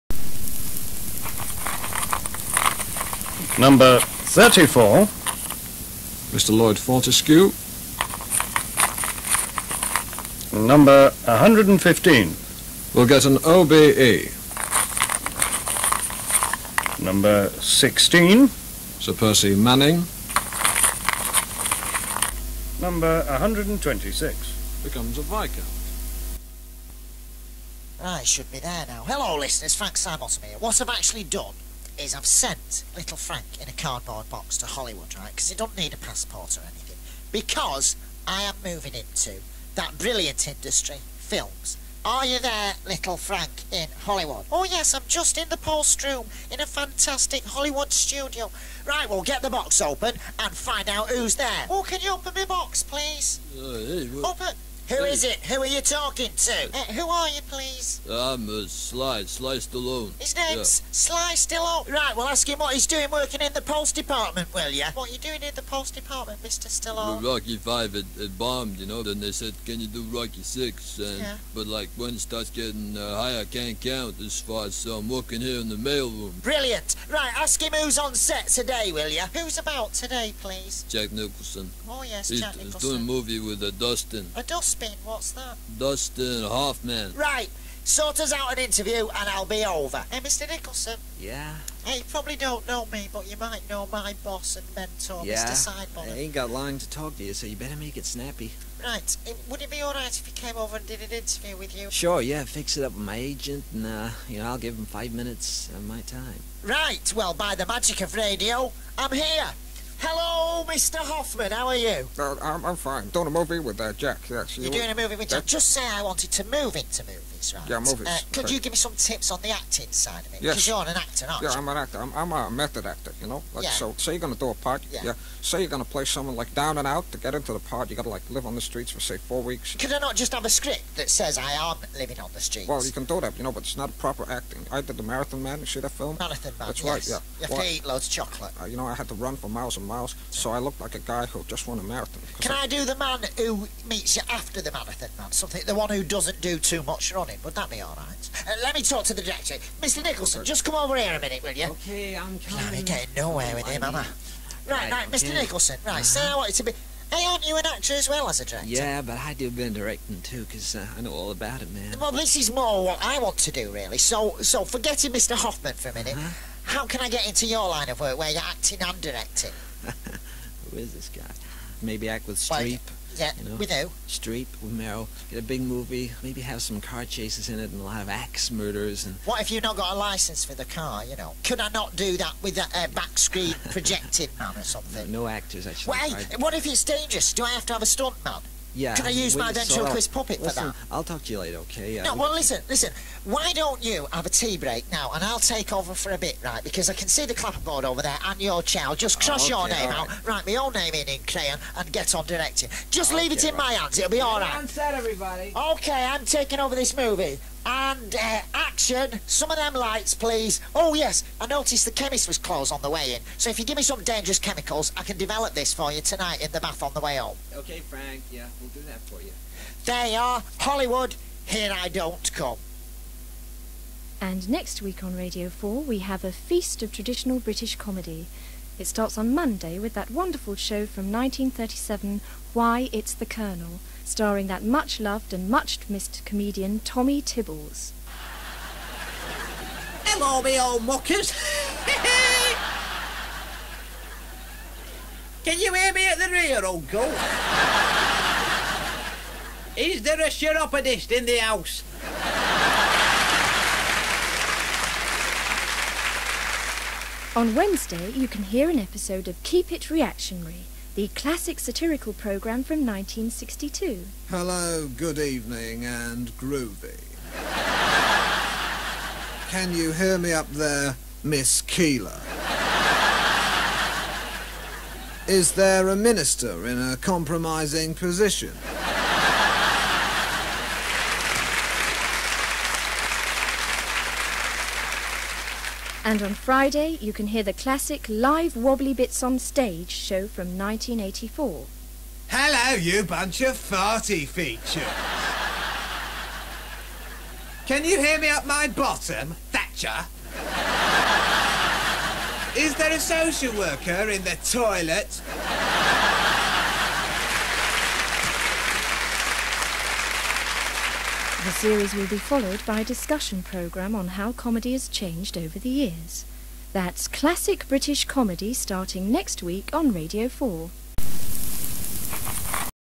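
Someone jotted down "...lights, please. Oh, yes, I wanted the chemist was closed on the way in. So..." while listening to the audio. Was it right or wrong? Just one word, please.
wrong.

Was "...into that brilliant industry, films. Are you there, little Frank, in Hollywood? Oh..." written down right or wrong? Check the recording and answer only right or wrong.
right.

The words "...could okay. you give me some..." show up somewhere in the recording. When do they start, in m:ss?
1:58.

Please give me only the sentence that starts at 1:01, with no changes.
Right, well, ask him what he's doing working in the pulse Department, will you?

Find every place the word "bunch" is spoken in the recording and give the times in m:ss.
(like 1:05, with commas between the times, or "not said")
4:53.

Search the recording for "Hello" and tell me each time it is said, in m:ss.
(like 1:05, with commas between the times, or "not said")
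0:29, 1:50, 4:00, 4:24, 4:52.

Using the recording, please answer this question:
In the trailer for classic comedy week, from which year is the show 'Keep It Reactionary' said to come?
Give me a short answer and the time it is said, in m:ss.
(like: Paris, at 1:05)
1962, at 4:22.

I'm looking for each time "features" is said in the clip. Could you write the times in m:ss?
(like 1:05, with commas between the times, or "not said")
4:54.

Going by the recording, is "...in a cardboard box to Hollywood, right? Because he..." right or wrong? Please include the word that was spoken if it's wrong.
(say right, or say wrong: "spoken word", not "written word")
right.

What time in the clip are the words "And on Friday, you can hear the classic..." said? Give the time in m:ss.
4:46.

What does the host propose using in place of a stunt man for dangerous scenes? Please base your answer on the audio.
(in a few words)
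ventriloquist puppet.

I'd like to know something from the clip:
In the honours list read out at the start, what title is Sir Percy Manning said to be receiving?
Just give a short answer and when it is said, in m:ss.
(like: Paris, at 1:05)
Viscount, at 0:24.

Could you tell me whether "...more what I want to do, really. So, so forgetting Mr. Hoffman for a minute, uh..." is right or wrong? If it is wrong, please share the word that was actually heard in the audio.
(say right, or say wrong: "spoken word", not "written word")
right.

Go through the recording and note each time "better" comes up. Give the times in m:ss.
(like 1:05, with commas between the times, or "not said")
1:37.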